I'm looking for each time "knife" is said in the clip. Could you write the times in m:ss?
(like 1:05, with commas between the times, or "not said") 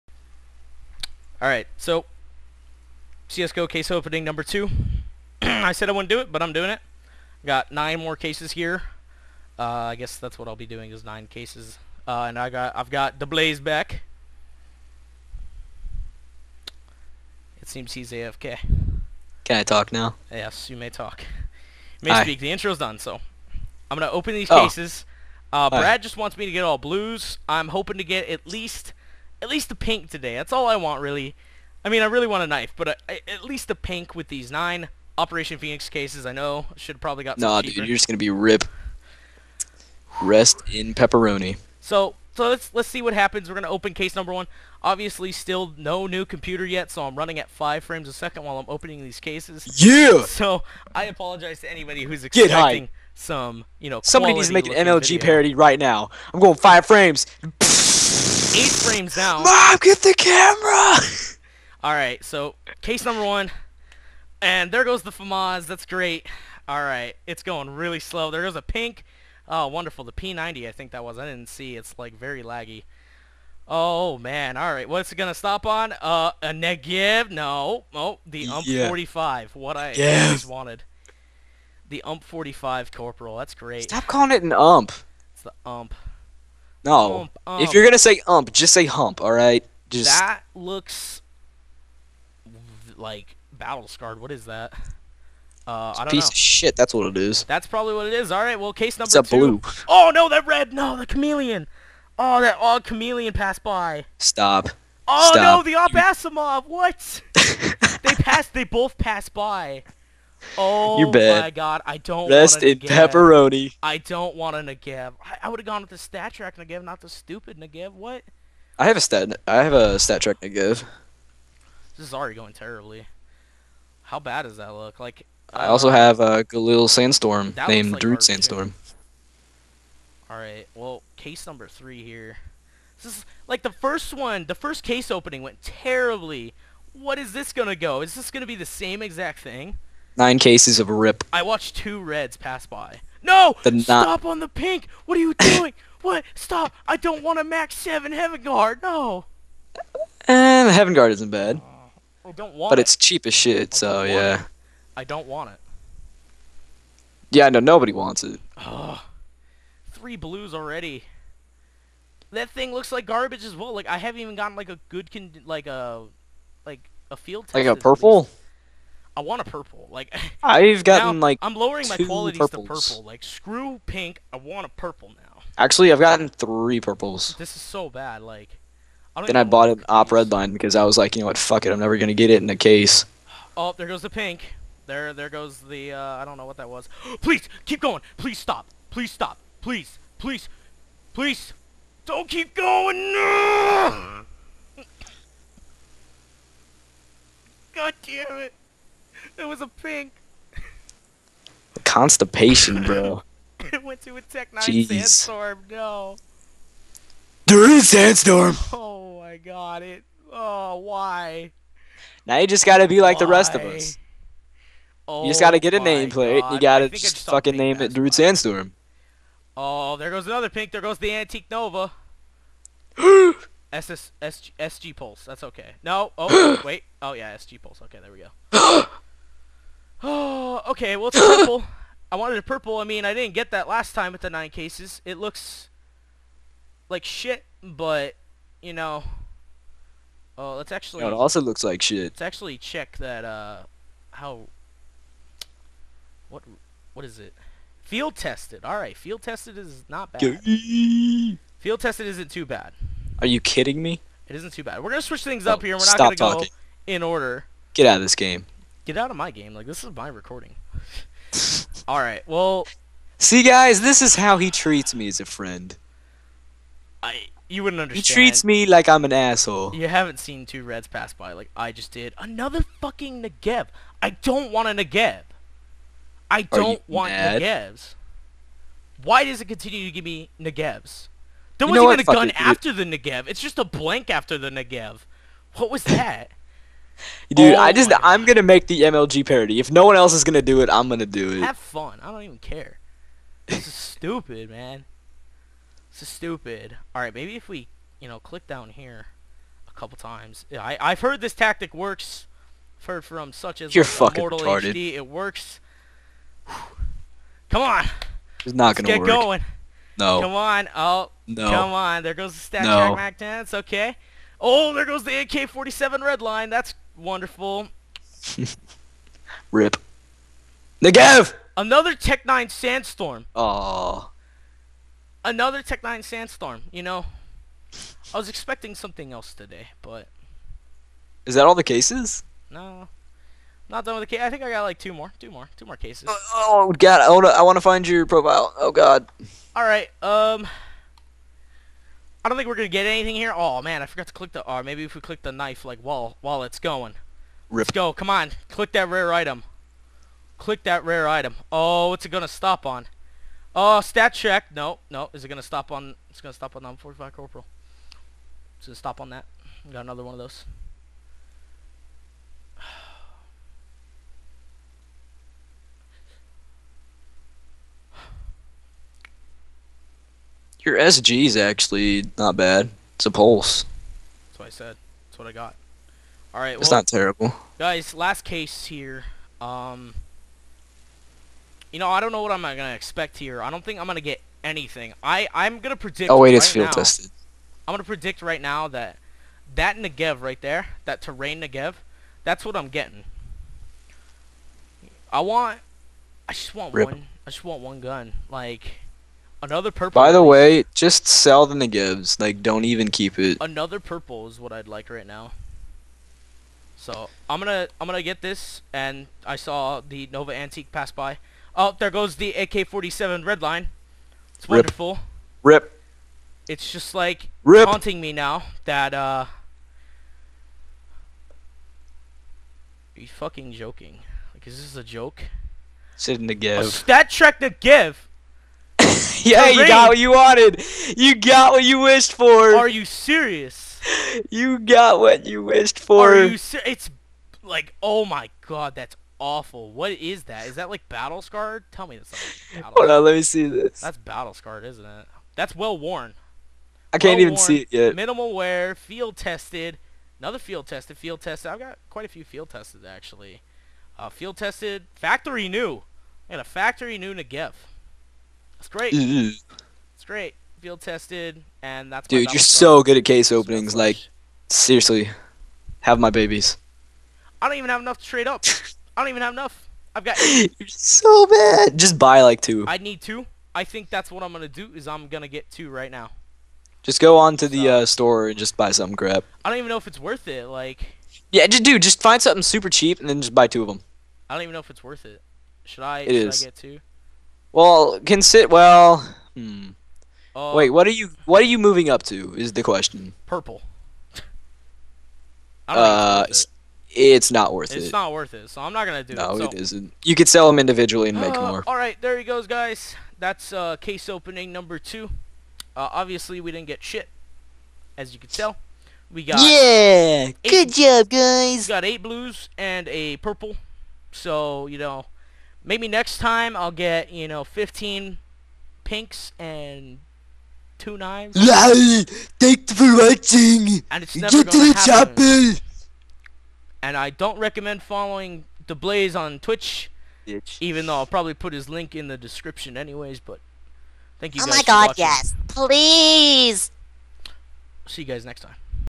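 0:32, 5:45.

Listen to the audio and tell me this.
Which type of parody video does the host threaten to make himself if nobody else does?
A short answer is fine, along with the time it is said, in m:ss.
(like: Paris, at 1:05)
MLG parody, at 4:48.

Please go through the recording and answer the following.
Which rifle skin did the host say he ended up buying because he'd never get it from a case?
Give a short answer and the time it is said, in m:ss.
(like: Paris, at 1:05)
Op red line, at 2:59.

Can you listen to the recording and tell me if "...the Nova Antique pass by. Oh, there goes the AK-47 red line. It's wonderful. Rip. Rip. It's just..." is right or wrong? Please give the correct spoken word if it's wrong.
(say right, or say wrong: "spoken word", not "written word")
right.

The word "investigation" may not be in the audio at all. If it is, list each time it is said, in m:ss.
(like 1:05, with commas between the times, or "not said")
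not said.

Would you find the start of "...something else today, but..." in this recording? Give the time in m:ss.
5:28.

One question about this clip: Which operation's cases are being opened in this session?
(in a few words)
Operation Phoenix.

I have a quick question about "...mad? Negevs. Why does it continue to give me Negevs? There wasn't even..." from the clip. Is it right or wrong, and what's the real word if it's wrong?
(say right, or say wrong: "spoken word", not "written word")
right.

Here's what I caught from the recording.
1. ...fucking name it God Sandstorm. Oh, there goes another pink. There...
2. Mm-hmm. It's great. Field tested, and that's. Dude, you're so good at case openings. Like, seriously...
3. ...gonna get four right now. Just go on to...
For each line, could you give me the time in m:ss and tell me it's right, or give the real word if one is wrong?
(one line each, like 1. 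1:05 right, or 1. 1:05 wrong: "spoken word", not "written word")
1. 3:37 wrong: "Drew", not "God"
2. 7:38 right
3. 7:55 wrong: "two", not "four".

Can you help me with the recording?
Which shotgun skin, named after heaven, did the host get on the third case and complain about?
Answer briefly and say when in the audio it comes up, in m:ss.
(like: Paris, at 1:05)
MAG-7 Heaven Guard, at 2:27.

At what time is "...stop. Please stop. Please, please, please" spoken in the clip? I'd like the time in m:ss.
3:08.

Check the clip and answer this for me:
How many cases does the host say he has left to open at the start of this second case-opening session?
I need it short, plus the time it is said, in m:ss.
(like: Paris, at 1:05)
9, at 0:07.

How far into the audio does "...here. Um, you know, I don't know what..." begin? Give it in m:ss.
6:18.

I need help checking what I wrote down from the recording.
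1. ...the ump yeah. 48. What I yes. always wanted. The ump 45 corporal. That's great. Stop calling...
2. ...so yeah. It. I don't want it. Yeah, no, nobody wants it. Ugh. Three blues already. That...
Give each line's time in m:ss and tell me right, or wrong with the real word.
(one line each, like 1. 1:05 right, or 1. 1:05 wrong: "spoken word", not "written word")
1. 1:18 wrong: "45", not "48"
2. 2:33 right.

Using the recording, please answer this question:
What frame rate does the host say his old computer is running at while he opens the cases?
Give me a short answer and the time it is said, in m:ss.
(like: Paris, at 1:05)
5 frames a second, at 0:47.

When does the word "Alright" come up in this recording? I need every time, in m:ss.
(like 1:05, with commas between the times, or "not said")
0:01, 1:01, 1:06, 2:10, 4:08.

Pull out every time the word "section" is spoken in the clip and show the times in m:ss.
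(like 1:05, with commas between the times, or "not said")
not said.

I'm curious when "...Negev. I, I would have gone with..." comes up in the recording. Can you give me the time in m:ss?
1:54.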